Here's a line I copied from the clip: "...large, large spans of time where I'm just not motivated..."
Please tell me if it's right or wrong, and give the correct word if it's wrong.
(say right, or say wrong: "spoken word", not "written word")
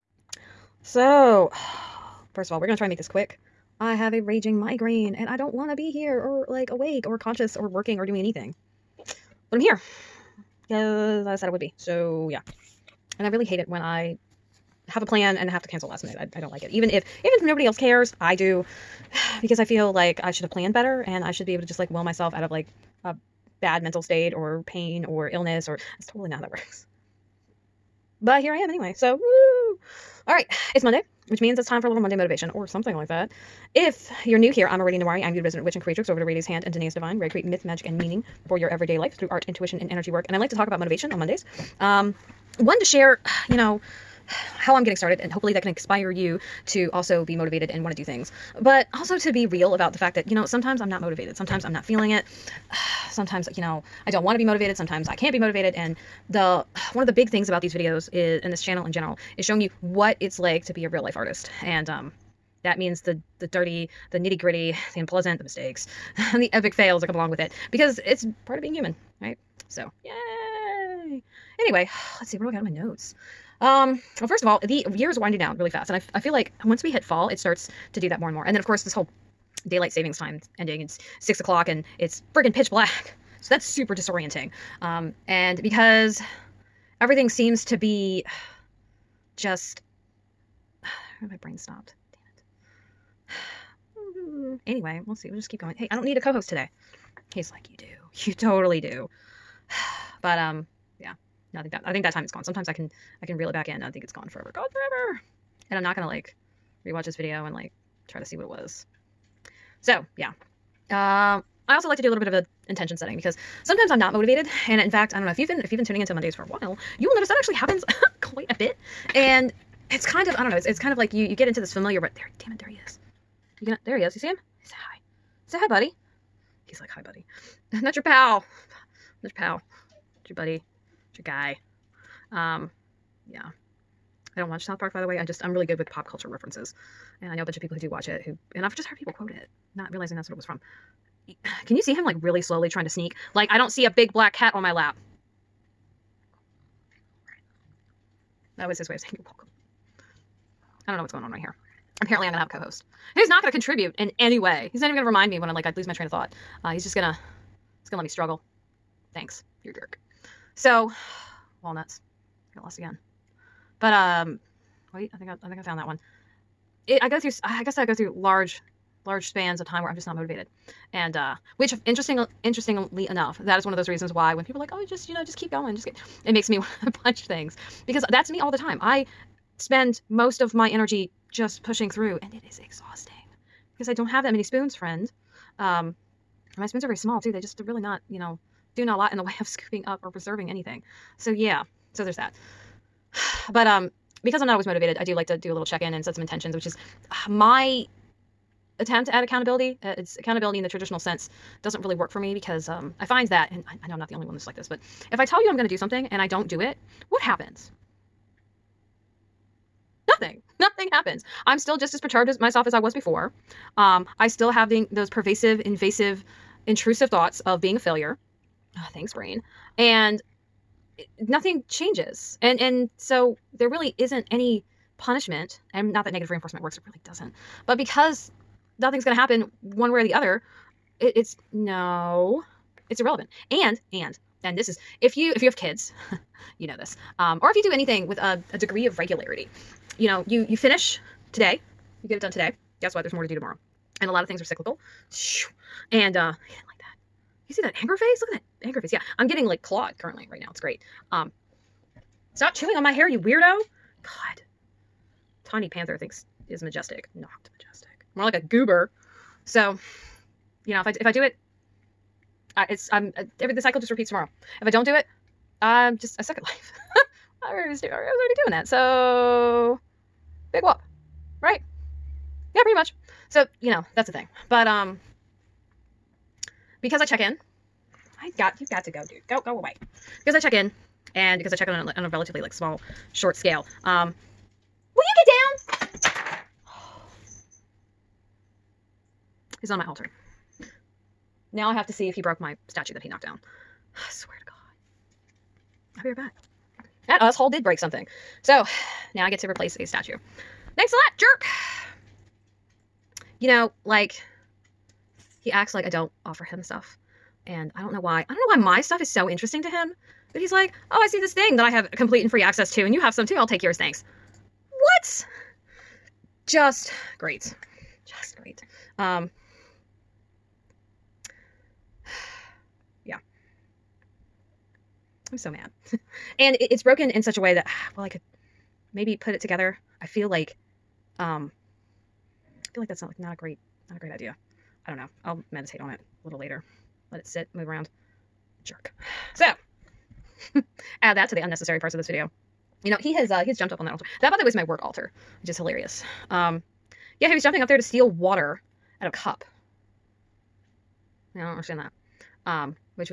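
right.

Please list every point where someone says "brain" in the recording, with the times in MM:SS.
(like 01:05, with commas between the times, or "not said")
01:31, 03:39.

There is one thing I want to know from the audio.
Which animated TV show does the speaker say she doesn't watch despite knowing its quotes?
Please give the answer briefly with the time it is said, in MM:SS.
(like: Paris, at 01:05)
South Park, at 02:14.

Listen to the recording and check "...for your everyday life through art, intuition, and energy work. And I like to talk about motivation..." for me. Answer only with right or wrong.
right.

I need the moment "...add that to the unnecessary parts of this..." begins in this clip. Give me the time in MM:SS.
05:41.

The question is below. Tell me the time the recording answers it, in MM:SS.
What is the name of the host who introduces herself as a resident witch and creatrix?
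00:34.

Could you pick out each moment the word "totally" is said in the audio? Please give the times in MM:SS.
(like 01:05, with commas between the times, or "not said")
00:26, 01:38.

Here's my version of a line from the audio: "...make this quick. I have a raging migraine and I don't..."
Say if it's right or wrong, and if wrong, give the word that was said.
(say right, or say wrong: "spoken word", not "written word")
right.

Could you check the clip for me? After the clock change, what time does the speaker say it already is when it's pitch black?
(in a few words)
6 o'clock.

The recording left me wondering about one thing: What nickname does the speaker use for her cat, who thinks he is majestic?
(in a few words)
Tiny Panther.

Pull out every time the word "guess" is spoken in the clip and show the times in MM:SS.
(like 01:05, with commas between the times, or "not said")
02:47, 04:02.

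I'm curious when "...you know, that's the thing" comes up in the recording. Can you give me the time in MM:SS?
04:33.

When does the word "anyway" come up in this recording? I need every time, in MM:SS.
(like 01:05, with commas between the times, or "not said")
00:28, 01:11, 01:34.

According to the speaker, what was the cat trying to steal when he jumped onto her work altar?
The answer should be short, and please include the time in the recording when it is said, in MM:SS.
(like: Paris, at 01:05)
water, at 05:48.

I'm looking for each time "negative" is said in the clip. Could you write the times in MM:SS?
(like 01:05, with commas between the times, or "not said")
03:46.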